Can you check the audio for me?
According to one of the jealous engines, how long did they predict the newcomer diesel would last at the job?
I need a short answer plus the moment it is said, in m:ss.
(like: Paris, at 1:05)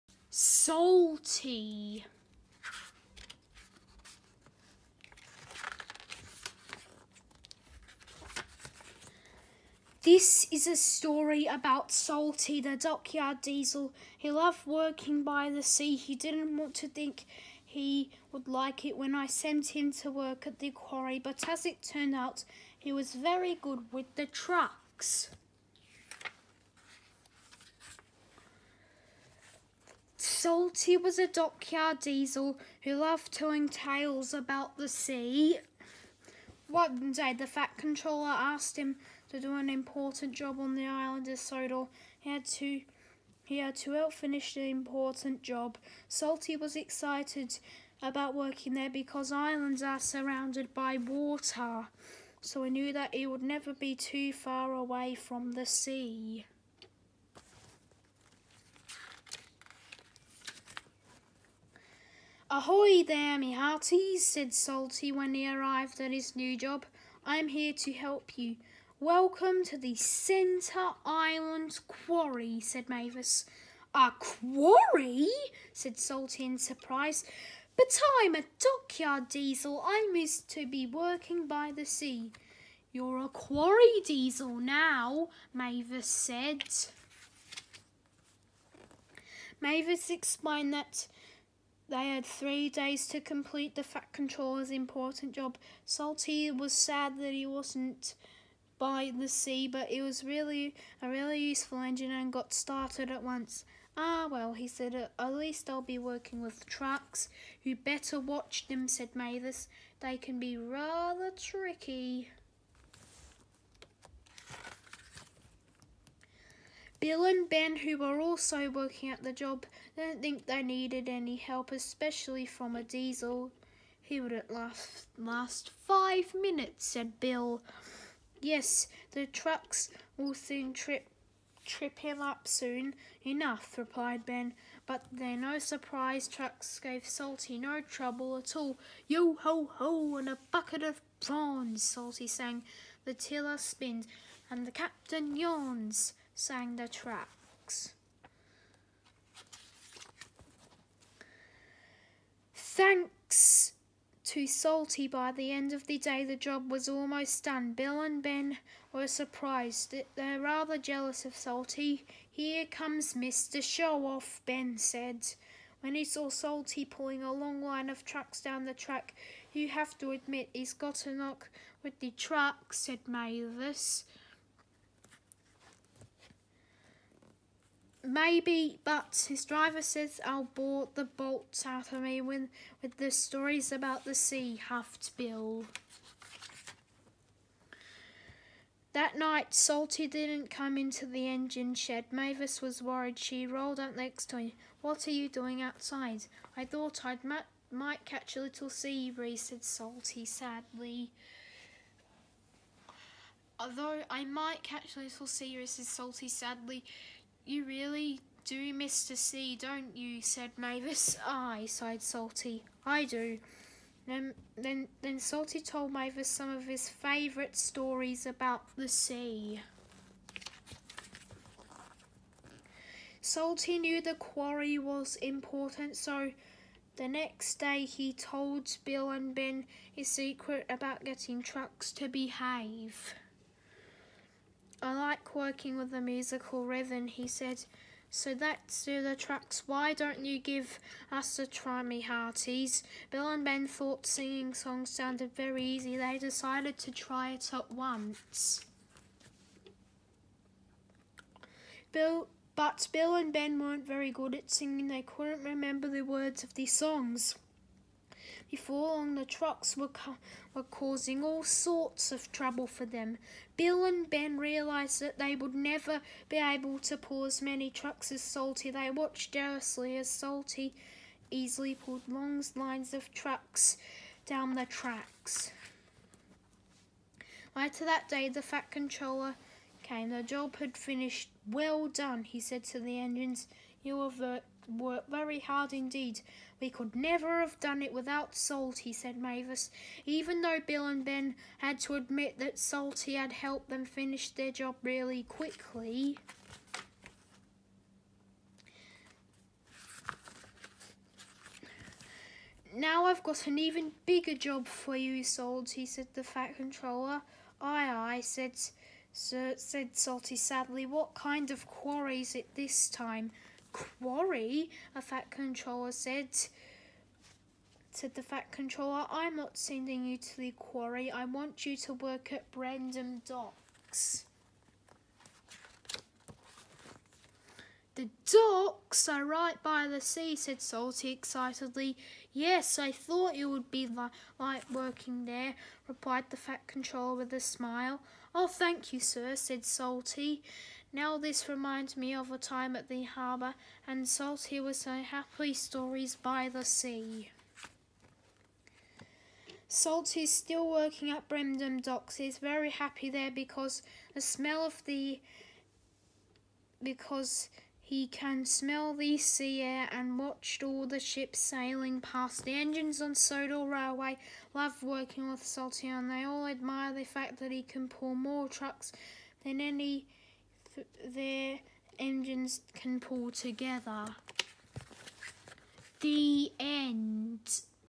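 5 minutes, at 2:05.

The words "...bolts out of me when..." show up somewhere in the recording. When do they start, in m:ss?
3:01.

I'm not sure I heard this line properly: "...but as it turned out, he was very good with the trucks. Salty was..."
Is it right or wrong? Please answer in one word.
right.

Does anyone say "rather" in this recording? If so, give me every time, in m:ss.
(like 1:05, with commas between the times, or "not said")
1:50, 2:40.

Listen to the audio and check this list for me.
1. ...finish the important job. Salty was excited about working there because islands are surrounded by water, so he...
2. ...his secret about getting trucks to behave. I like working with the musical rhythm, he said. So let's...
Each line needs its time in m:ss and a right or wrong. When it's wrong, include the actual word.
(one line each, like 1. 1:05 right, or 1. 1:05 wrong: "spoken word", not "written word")
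1. 0:44 right
2. 3:49 right.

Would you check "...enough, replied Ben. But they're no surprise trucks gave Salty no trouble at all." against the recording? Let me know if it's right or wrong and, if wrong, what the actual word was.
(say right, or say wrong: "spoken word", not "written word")
right.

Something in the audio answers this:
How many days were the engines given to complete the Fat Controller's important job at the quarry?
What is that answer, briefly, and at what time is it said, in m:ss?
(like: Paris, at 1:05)
3, at 1:32.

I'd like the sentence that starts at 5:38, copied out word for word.
Oh, thank you, sir, said Salty.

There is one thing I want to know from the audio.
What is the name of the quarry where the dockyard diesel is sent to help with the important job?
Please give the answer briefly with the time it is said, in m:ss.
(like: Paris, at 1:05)
Centre Island Quarry, at 1:09.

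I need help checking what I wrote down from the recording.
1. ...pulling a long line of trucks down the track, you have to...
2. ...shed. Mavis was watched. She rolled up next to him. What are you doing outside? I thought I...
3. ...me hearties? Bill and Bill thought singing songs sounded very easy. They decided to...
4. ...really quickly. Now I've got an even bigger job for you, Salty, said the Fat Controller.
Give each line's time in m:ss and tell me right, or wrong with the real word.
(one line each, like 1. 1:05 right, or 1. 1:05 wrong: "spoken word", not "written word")
1. 2:46 right
2. 3:11 wrong: "worried", not "watched"
3. 4:01 wrong: "Ben", not "Bill"
4. 4:54 right.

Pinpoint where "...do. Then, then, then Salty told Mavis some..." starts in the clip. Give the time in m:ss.
3:33.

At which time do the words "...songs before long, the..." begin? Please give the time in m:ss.
4:16.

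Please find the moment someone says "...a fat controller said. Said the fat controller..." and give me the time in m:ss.
5:14.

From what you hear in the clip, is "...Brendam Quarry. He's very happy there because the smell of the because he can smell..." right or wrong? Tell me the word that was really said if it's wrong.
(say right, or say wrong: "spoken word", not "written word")
wrong: "Docks", not "Quarry".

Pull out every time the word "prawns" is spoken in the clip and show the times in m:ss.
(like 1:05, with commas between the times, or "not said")
2:21.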